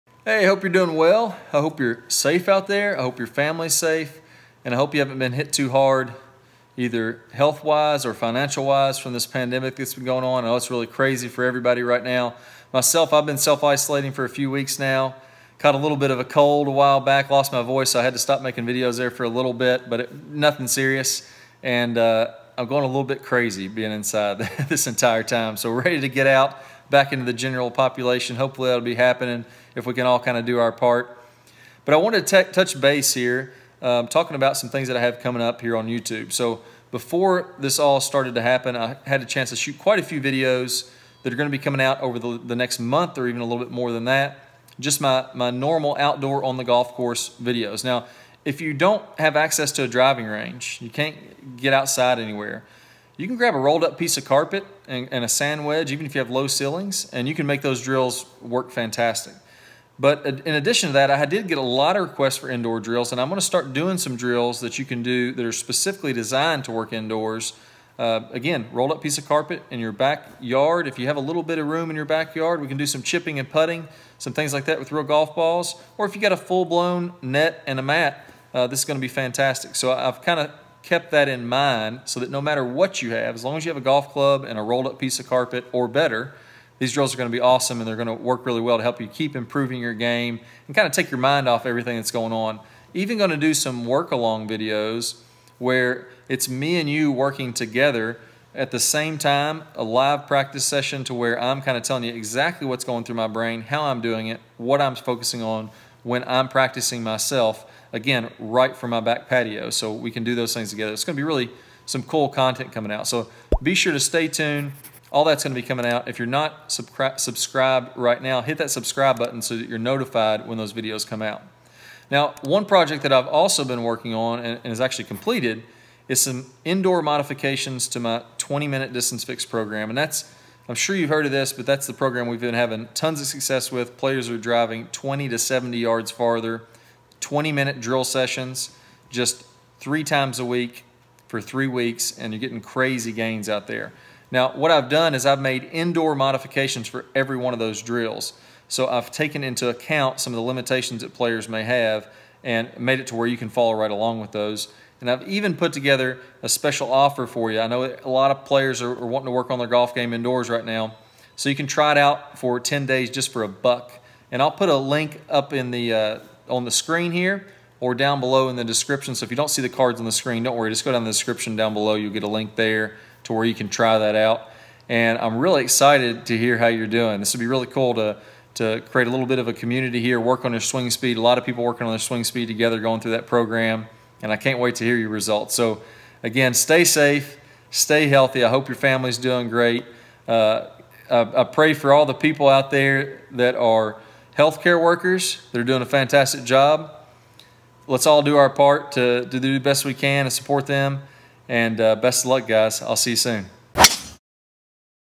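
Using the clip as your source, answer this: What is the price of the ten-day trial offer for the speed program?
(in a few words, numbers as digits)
A buck.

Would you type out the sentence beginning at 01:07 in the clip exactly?
Uh, again, rolled up piece of carpet in your backyard.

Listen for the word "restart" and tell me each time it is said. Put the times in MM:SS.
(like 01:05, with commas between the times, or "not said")
not said.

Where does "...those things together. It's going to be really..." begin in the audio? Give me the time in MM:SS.
01:50.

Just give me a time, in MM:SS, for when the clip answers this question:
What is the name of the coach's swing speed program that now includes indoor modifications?
02:08.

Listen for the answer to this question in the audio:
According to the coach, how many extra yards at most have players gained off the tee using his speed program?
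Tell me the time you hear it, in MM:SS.
02:15.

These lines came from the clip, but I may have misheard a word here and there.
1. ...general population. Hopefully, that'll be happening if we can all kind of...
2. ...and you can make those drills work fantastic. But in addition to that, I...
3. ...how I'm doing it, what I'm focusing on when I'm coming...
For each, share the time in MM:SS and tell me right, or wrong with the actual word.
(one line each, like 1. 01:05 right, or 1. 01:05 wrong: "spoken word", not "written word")
1. 00:27 right
2. 00:57 right
3. 01:43 wrong: "practicing", not "coming".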